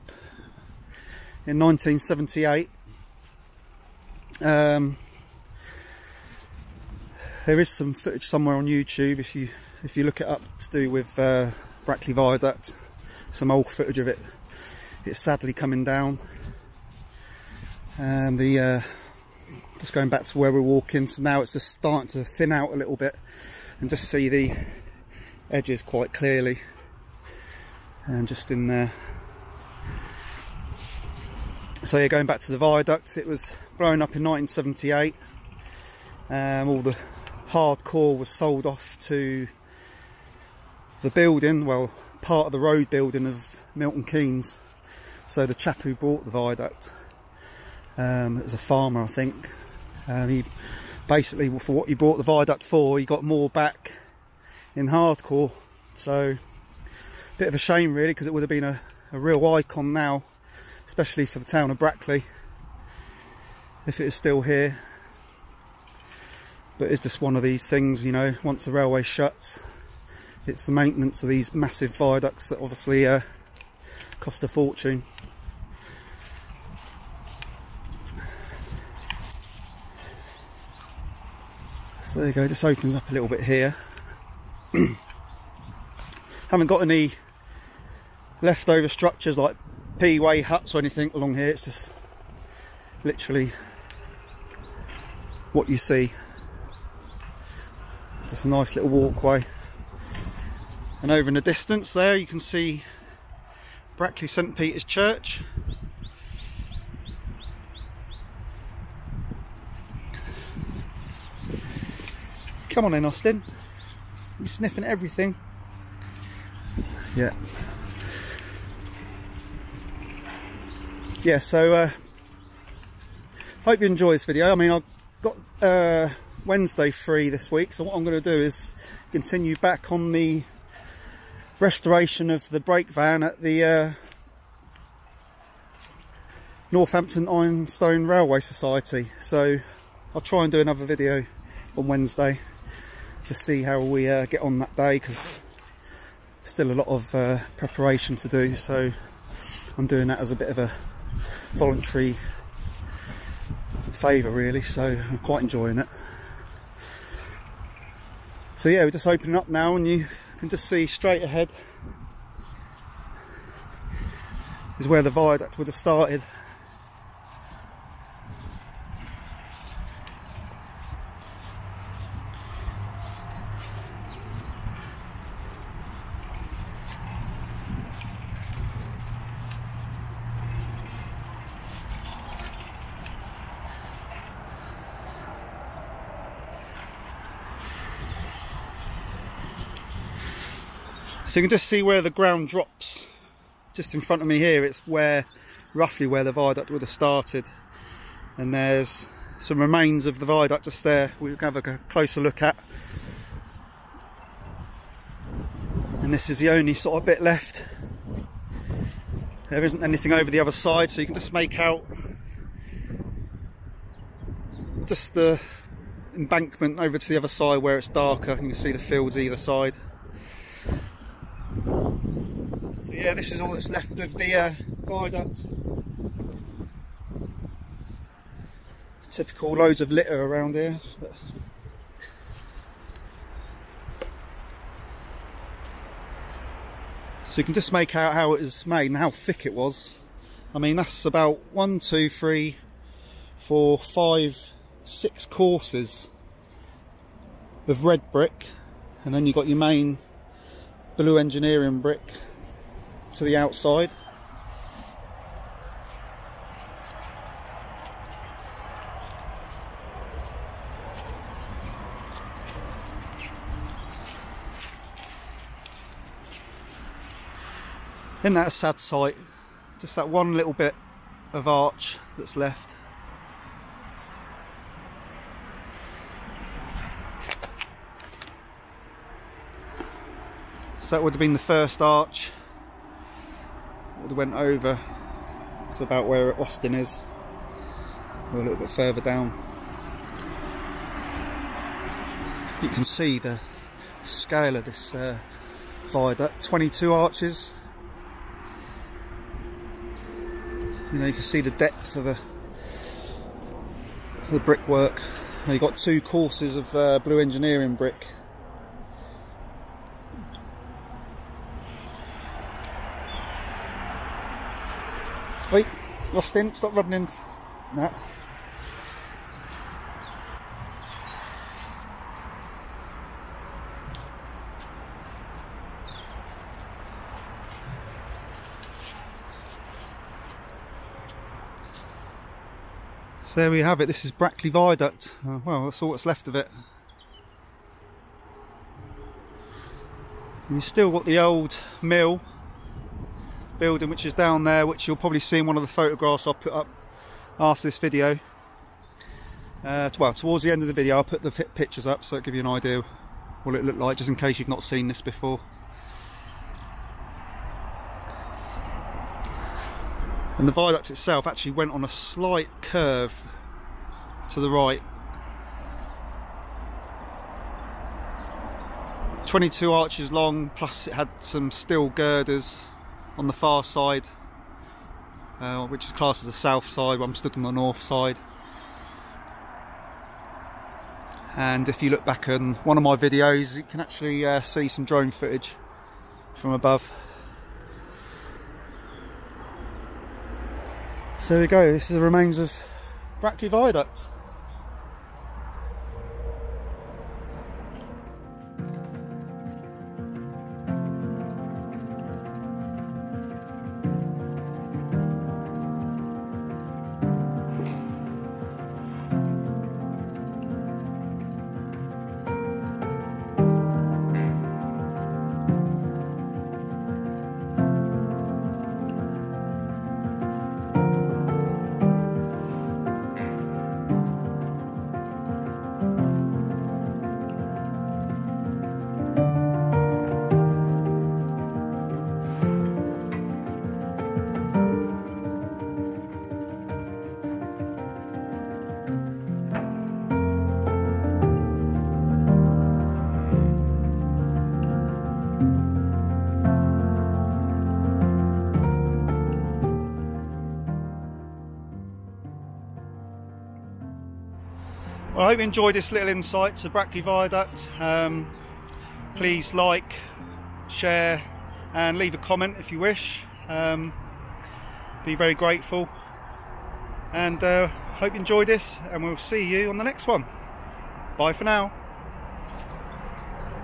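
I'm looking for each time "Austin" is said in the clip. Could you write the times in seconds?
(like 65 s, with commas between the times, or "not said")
113 s, 286 s, 316 s.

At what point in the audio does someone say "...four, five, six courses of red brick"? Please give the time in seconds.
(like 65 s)
243 s.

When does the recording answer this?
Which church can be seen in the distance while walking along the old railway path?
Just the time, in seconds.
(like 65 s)
103 s.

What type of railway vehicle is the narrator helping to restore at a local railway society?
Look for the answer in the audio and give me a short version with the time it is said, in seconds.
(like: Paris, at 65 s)
Brake van, at 132 s.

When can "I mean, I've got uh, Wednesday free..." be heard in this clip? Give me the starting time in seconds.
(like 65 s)
124 s.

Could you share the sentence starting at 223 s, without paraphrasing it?
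yeah, this is all that's left of the uh, viaduct.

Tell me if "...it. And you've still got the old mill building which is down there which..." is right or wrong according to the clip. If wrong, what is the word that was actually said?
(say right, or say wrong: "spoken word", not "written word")
right.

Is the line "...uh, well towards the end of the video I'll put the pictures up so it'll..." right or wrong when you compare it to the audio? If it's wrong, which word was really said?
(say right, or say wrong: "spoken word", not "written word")
right.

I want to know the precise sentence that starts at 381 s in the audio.
And if you look back on one of my videos, you can actually uh, see some drone footage from above.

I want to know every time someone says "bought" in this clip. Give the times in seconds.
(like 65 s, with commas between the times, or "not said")
45 s, 51 s.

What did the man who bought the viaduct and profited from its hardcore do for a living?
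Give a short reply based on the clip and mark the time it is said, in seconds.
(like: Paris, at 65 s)
Farmer, at 48 s.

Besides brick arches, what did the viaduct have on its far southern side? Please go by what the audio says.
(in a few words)
Steel girders.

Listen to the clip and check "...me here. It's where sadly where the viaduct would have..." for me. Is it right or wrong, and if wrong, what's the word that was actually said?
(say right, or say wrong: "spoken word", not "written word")
wrong: "roughly", not "sadly".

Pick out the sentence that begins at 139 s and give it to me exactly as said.
So I'll try and do another video on Wednesday.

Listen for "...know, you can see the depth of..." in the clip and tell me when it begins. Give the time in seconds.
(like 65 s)
300 s.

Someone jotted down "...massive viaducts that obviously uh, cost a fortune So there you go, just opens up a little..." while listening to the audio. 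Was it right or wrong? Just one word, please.
right.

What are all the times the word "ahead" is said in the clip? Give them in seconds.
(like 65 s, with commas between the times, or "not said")
161 s.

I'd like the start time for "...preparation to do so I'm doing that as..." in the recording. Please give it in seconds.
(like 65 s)
147 s.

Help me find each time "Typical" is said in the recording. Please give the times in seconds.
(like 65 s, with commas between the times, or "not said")
229 s.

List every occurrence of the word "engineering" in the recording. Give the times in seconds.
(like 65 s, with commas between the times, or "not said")
251 s, 307 s.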